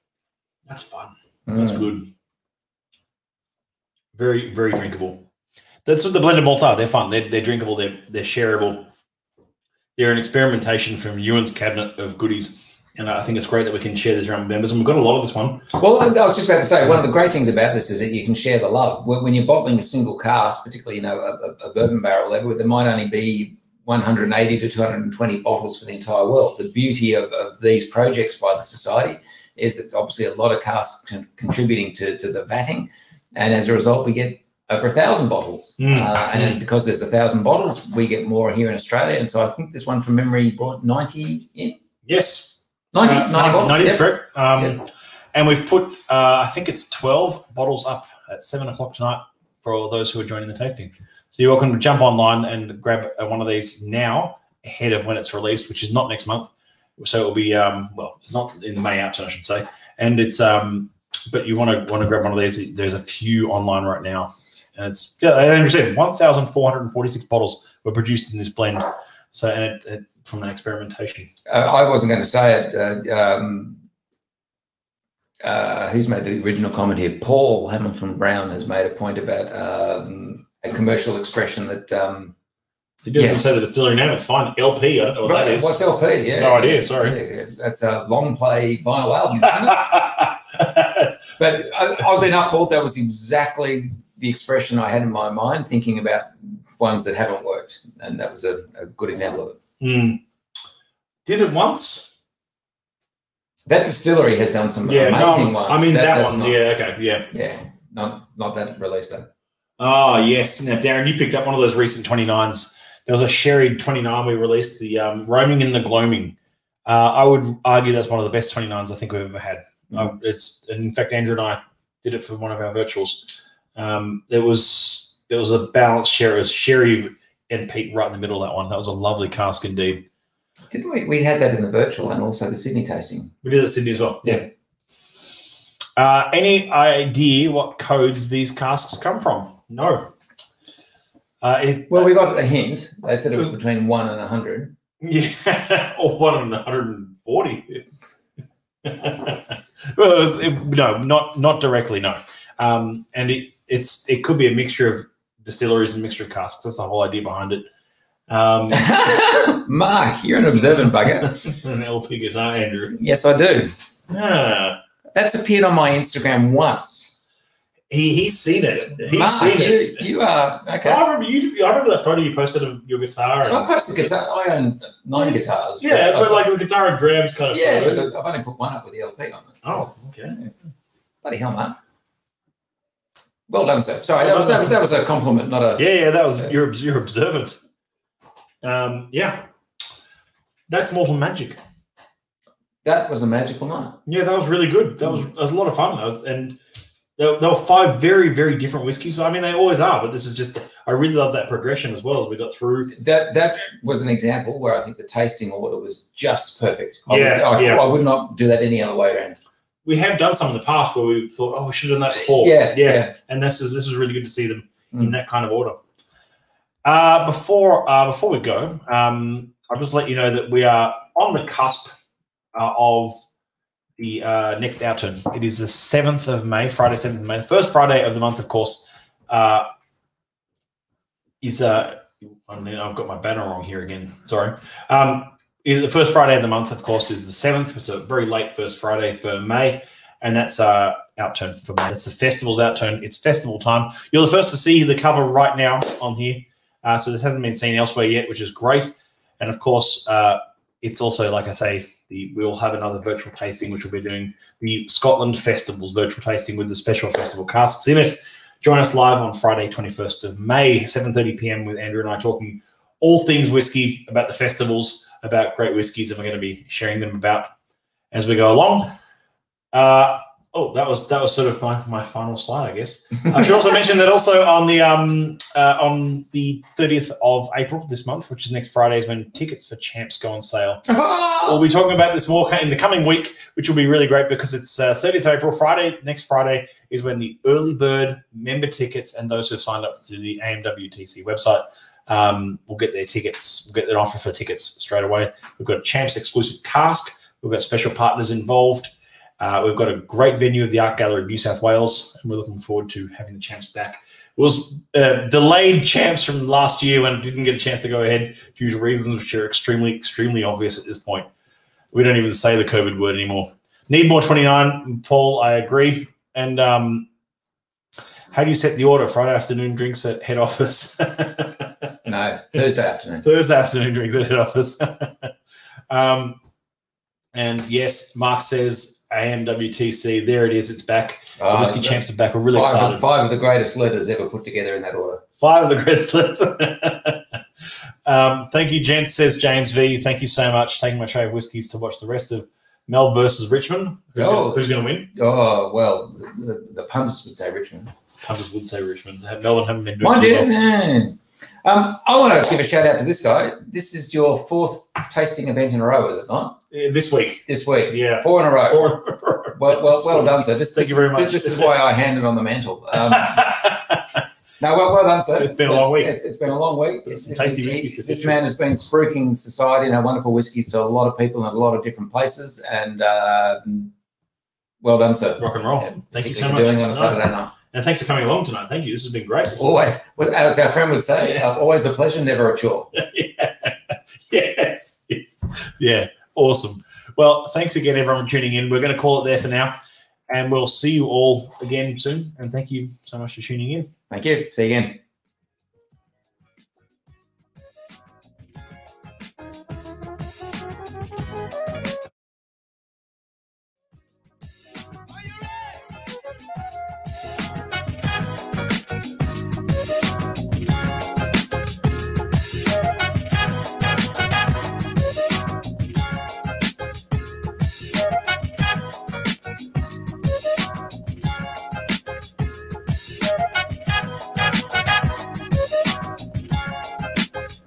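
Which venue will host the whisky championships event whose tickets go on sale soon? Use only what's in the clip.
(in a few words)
Art Gallery of New South Wales.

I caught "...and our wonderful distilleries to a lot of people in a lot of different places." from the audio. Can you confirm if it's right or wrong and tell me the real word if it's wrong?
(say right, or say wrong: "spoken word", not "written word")
wrong: "whiskies", not "distilleries".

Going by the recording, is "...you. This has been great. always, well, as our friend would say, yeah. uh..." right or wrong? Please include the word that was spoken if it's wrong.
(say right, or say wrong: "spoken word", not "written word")
right.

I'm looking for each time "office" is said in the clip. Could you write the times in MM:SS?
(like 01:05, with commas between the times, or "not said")
05:20, 05:24.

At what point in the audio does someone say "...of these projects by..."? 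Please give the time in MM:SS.
00:27.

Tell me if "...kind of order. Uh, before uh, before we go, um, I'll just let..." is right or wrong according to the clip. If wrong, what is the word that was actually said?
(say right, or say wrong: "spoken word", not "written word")
right.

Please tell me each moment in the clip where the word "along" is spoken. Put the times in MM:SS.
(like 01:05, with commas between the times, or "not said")
04:28, 06:18.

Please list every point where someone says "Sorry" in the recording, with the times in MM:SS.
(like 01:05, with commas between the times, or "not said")
01:26, 03:04, 03:54.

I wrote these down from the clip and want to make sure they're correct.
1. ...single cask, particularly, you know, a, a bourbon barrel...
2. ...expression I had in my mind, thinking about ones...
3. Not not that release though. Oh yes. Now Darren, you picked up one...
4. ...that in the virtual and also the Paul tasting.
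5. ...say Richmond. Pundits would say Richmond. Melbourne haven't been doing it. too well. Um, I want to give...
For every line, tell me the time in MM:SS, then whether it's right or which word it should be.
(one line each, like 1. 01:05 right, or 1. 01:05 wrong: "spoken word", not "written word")
1. 00:19 right
2. 01:34 right
3. 01:47 right
4. 02:11 wrong: "Sydney", not "Paul"
5. 05:47 right.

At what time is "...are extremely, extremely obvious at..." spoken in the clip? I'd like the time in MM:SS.
05:09.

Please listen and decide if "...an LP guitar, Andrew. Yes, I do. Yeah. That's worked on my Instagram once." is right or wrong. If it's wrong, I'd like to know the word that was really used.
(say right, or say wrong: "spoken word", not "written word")
wrong: "appeared", not "worked".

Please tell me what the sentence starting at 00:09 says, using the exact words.
They're an experimentation from Ewan's cabinet of goodies.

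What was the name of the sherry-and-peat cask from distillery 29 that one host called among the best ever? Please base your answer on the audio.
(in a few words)
Roaming in the Gloaming.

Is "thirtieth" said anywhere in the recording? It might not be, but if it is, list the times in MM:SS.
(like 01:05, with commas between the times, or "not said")
04:36, 04:44.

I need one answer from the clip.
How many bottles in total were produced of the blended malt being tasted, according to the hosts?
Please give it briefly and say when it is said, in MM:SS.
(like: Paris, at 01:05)
1446, at 01:05.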